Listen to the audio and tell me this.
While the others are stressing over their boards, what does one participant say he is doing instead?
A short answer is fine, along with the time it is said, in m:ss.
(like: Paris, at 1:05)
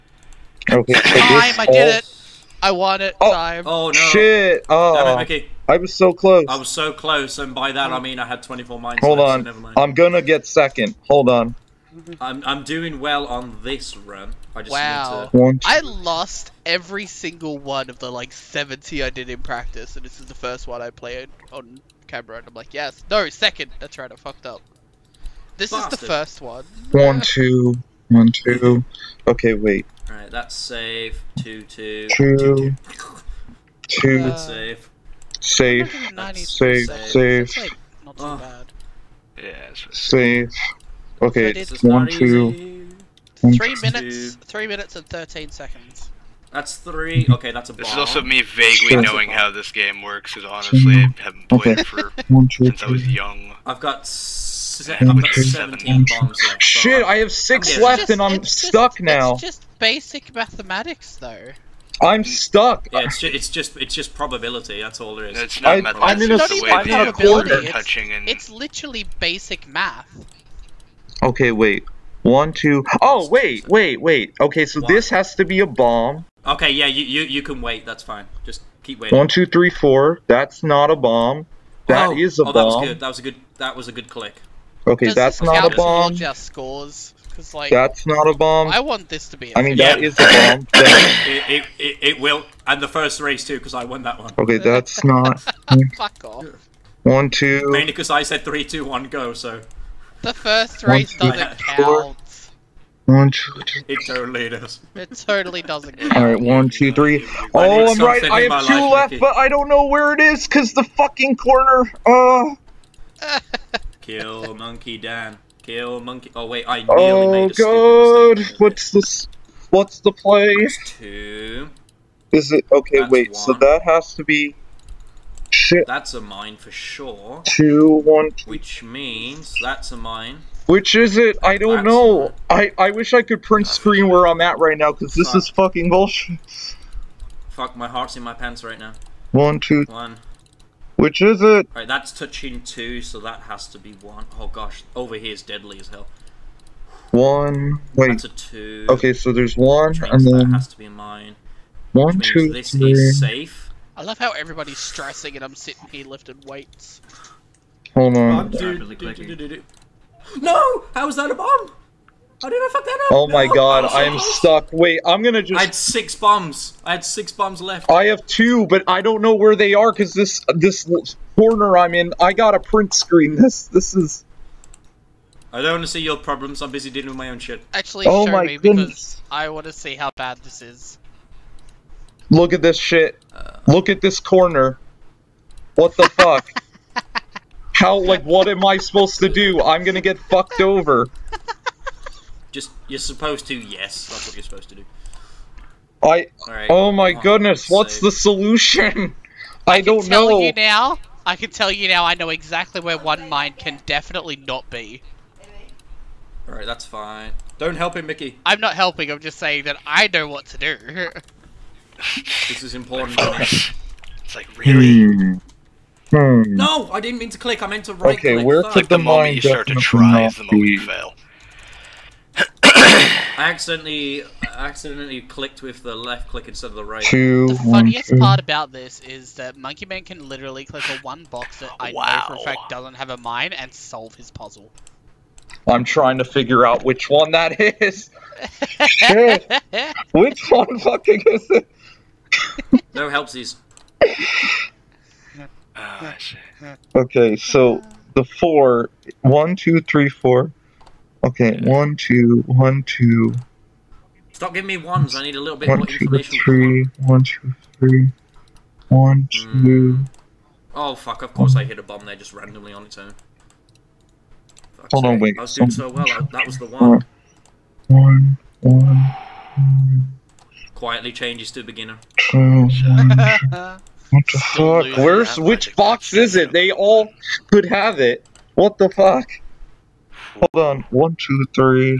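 lifting weights, at 2:36.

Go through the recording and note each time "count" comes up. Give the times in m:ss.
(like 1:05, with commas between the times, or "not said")
1:41.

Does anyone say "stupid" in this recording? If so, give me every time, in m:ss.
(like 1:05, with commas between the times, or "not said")
1:58.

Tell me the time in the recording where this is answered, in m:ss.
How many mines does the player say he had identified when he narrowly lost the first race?
0:08.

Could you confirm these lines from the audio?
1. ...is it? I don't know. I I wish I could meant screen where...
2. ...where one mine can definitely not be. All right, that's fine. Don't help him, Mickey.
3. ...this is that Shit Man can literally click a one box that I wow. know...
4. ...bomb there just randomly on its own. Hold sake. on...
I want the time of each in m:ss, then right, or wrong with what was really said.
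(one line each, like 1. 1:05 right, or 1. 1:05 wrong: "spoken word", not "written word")
1. 2:10 wrong: "print", not "meant"
2. 3:22 right
3. 3:48 wrong: "Monkey", not "Shit"
4. 4:21 right.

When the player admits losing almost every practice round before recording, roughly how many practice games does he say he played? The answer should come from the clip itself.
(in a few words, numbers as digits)
70.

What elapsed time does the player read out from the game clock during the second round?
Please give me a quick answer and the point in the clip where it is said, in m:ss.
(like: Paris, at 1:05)
3 minutes 13 seconds, at 0:44.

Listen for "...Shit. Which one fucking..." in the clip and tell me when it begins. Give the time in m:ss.
3:58.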